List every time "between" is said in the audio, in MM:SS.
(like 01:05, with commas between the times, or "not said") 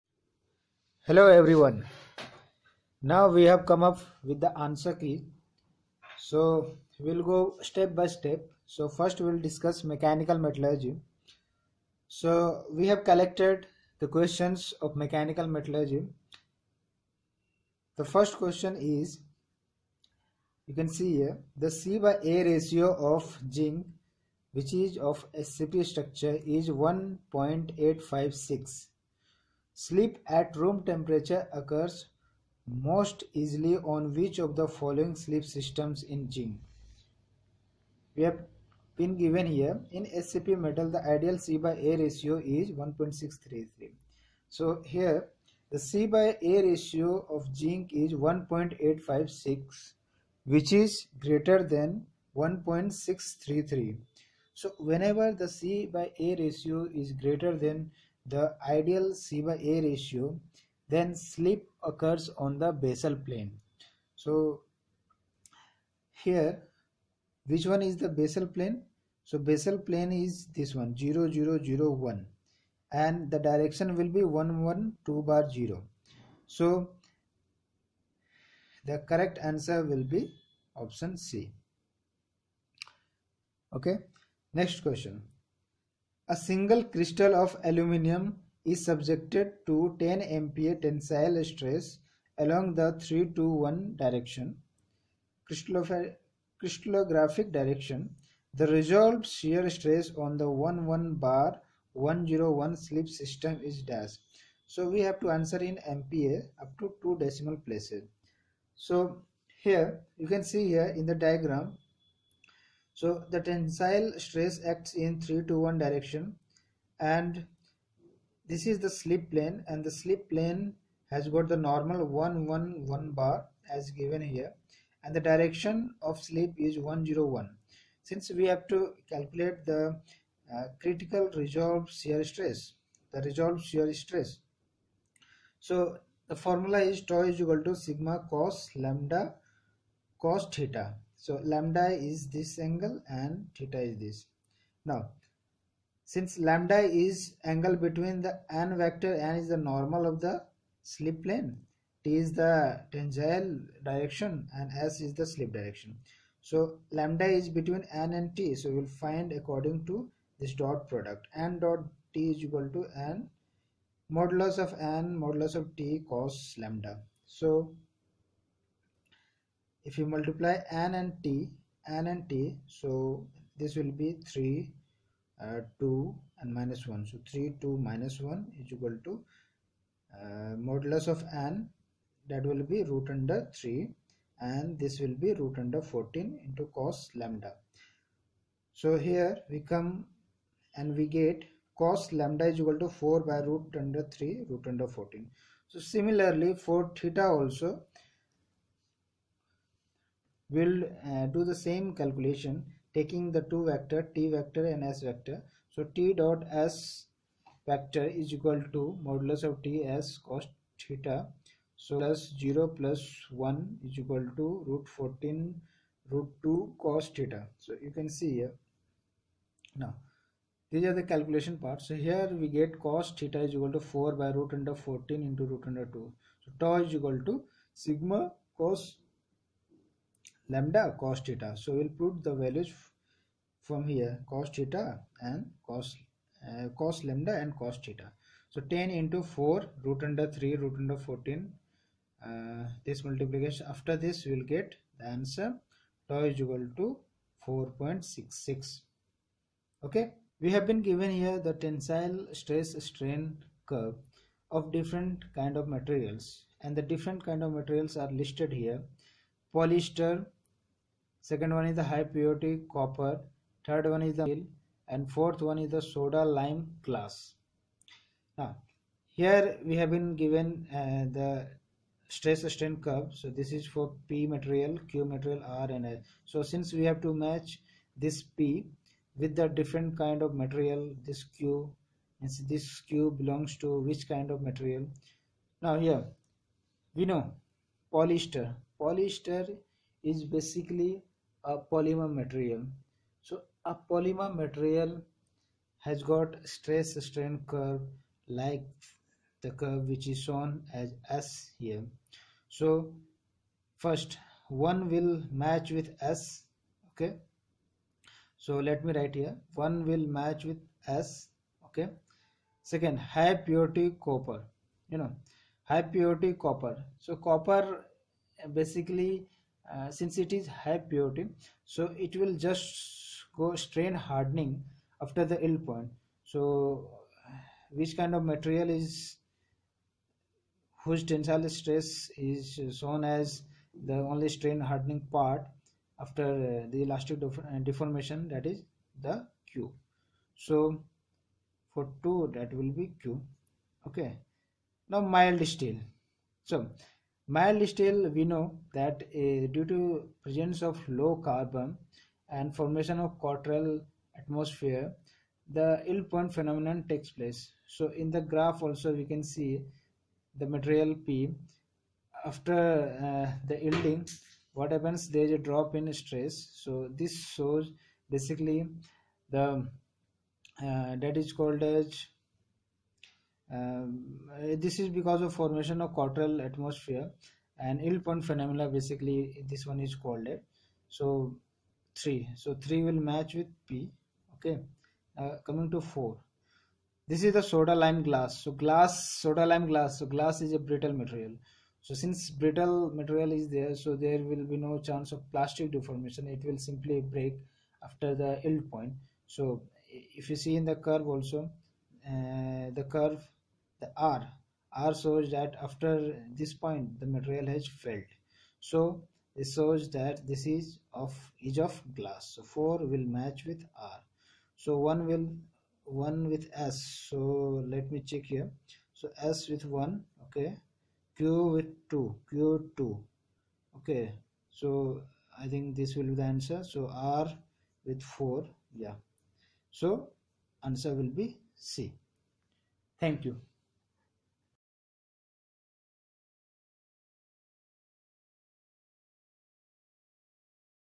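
02:27, 02:37.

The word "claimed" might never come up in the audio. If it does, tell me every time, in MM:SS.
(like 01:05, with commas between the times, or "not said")
not said.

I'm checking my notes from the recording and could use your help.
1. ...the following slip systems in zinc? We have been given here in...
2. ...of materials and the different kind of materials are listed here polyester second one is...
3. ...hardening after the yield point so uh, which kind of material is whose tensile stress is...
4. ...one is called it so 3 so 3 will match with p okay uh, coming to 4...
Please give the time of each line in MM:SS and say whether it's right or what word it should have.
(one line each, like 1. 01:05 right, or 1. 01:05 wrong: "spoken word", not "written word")
1. 00:34 right
2. 04:15 right
3. 05:24 right
4. 06:19 right.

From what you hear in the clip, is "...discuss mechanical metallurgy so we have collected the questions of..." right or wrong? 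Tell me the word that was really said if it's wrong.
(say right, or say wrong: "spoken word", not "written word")
right.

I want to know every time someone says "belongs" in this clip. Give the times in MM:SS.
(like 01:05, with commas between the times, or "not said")
04:43.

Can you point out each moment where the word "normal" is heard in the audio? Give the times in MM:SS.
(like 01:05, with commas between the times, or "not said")
02:01, 02:29.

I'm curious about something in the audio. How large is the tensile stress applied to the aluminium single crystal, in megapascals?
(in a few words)
10 MPa.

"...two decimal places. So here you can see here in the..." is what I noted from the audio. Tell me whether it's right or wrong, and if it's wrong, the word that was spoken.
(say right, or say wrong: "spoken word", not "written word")
right.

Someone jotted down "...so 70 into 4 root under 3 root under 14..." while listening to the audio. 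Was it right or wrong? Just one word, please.
wrong.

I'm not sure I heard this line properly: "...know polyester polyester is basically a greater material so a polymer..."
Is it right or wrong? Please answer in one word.
wrong.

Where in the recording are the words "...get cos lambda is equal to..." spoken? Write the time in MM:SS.
03:11.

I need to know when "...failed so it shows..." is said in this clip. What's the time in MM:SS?
06:47.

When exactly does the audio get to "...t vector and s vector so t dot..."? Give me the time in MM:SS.
03:24.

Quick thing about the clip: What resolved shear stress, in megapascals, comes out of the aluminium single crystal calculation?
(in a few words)
4.66.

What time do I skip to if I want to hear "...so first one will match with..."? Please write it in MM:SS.
05:02.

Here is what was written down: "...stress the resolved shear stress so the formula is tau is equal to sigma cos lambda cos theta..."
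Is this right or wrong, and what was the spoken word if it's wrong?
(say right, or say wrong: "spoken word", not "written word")
right.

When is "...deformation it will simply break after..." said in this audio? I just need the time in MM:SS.
06:35.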